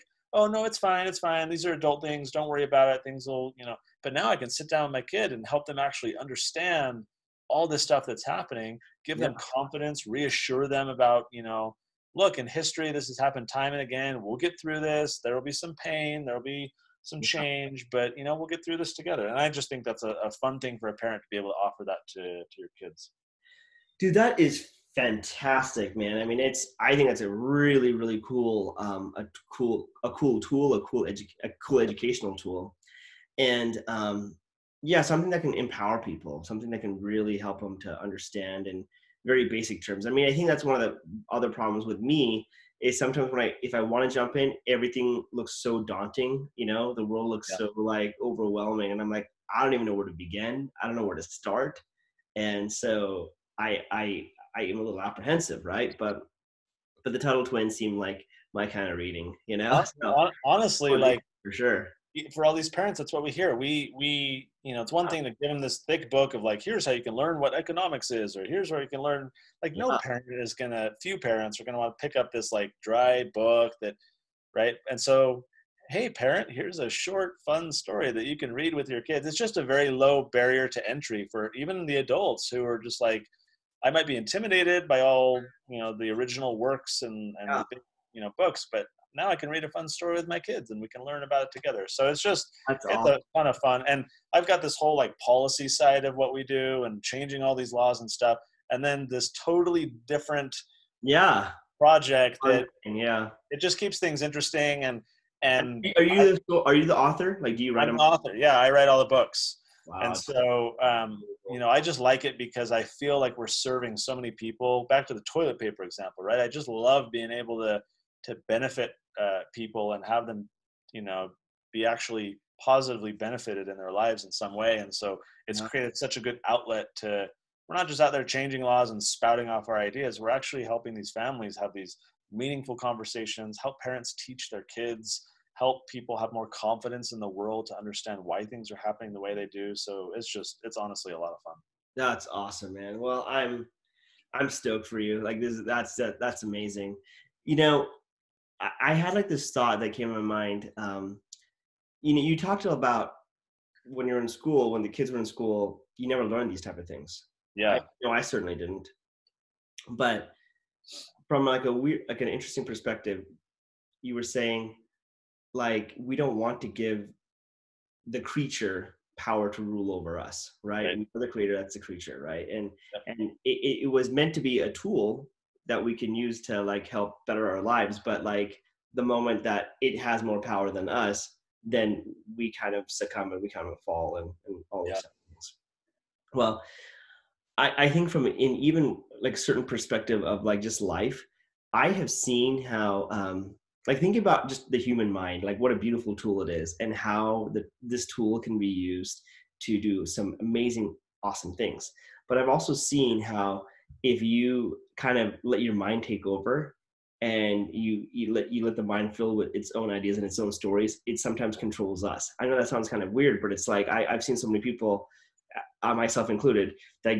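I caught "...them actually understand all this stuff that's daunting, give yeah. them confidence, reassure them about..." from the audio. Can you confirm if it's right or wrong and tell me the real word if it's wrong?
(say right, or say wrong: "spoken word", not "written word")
wrong: "happening", not "daunting".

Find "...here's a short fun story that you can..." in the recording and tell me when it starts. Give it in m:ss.
1:16.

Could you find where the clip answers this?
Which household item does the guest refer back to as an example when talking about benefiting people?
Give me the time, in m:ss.
1:55.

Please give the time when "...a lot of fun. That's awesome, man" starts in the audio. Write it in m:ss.
2:21.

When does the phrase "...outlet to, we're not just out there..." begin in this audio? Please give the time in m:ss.
2:06.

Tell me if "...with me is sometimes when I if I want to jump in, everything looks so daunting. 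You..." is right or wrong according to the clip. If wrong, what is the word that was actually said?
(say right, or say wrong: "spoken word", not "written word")
right.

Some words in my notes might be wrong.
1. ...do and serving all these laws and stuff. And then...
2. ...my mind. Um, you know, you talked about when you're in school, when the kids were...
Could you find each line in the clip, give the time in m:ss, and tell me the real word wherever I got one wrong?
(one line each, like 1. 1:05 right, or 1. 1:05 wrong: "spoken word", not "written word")
1. 1:36 wrong: "changing", not "serving"
2. 2:30 right.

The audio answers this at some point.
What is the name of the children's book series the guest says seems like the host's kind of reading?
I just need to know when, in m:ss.
0:57.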